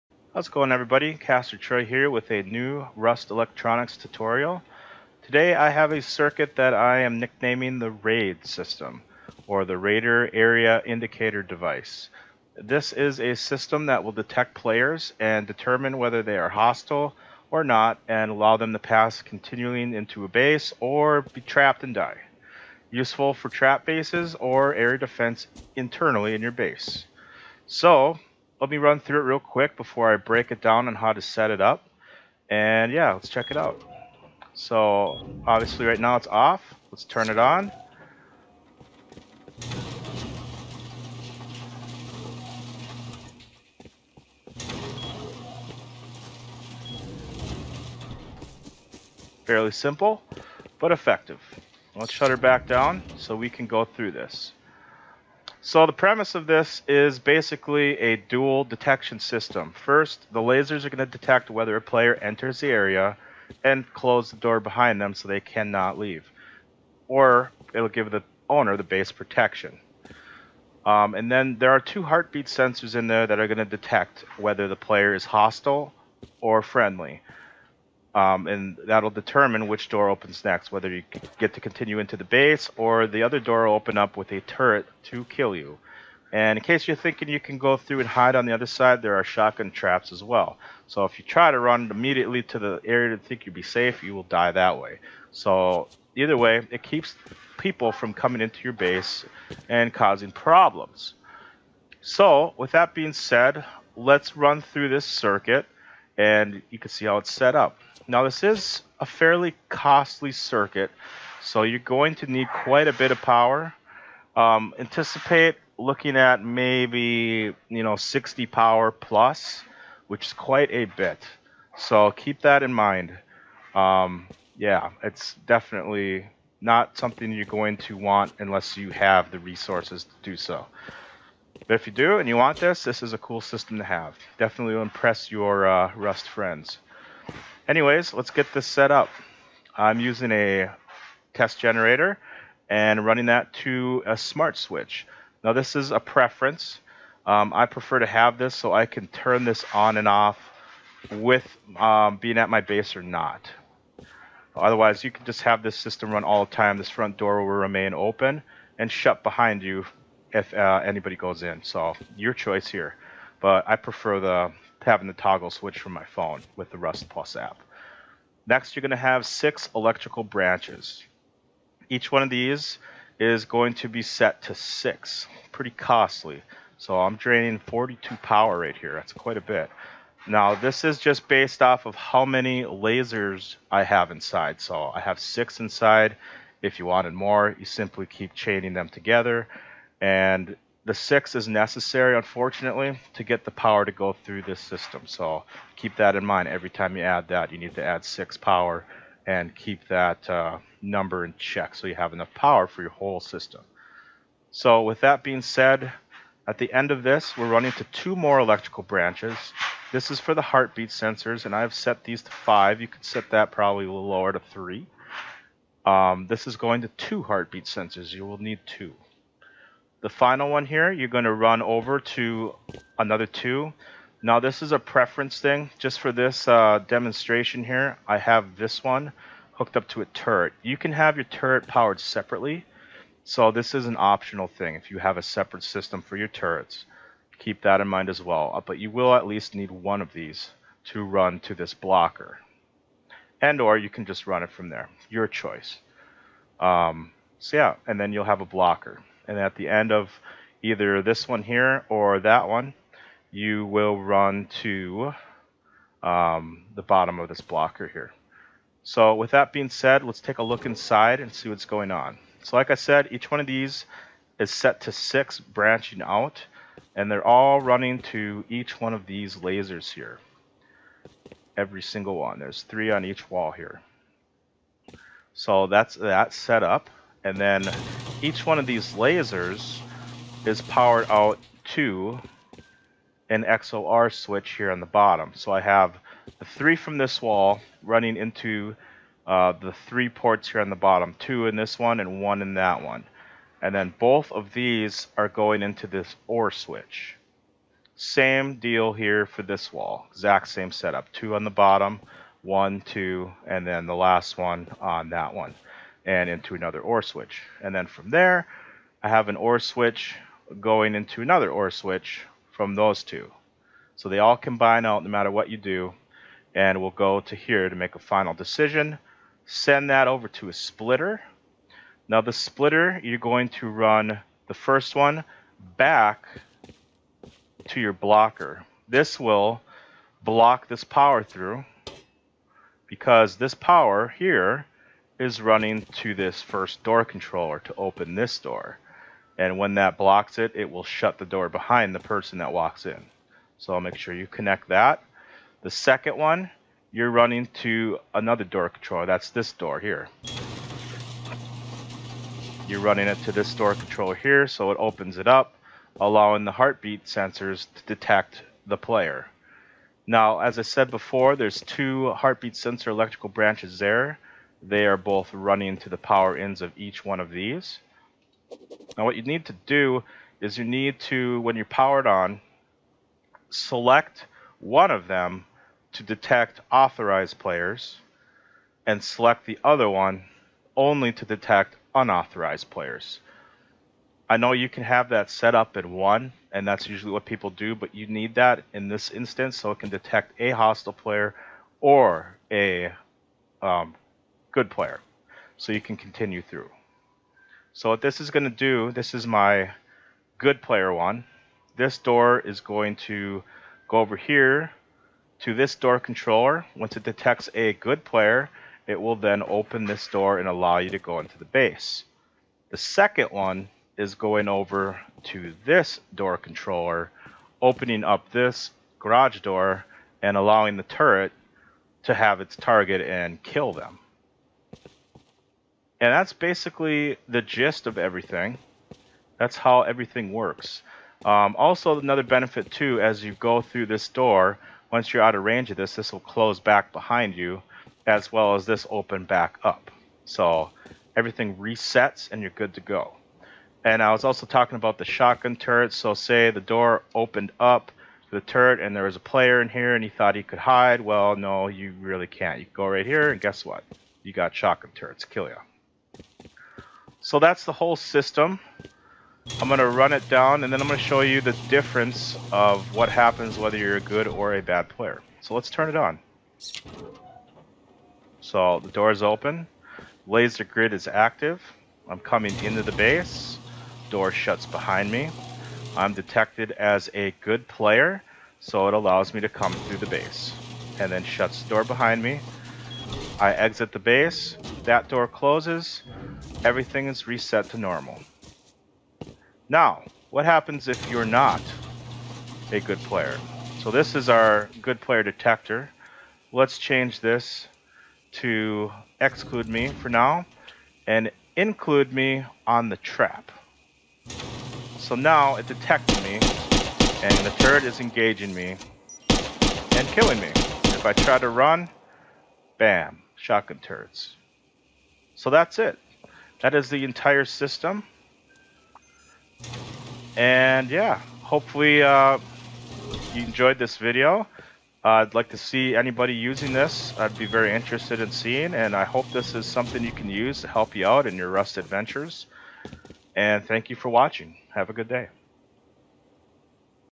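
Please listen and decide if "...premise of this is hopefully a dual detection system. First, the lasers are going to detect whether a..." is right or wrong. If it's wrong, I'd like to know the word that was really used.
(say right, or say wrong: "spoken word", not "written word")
wrong: "basically", not "hopefully".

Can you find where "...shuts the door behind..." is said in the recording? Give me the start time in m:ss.
8:01.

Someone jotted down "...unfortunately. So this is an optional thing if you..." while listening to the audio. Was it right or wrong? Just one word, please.
wrong.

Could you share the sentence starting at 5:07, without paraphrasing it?
And then from there, I have an OR switch going into another OR switch from those two.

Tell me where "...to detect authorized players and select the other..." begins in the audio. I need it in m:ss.
6:15.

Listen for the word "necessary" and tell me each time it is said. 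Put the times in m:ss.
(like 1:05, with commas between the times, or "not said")
3:11.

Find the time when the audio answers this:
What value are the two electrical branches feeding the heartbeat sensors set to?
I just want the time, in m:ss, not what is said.
3:32.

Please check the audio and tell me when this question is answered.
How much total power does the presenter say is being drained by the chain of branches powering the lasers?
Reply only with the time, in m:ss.
2:57.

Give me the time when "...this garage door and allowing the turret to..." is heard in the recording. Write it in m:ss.
6:58.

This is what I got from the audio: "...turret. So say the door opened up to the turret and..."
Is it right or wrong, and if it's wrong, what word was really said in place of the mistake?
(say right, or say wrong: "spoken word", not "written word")
right.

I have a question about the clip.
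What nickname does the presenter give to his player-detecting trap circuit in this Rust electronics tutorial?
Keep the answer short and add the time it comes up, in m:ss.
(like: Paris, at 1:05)
RAID system, at 0:07.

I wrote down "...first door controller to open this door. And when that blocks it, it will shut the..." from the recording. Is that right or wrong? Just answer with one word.
right.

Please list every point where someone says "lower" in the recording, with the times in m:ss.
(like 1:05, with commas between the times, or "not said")
3:34.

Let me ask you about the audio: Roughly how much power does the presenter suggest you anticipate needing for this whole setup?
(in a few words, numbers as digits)
60 power plus.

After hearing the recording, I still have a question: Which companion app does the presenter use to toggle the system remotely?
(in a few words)
Rust Plus.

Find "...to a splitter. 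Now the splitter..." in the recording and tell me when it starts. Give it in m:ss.
5:20.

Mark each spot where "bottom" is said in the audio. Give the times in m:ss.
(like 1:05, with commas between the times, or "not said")
4:16, 4:44, 4:50, 5:01.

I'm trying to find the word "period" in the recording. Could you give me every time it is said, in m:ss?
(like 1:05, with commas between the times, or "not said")
not said.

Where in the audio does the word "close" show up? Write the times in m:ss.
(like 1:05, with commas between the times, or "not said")
1:03, 7:16, 8:05.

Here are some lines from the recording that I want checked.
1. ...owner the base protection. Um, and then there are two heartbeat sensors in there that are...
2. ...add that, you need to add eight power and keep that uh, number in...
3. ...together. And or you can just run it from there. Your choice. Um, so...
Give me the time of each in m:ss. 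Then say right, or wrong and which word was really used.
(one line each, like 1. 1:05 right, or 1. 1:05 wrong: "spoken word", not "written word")
1. 1:08 right
2. 3:17 wrong: "six", not "eight"
3. 4:01 wrong: "blocker", not "together".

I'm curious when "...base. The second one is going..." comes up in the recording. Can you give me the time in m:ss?
6:51.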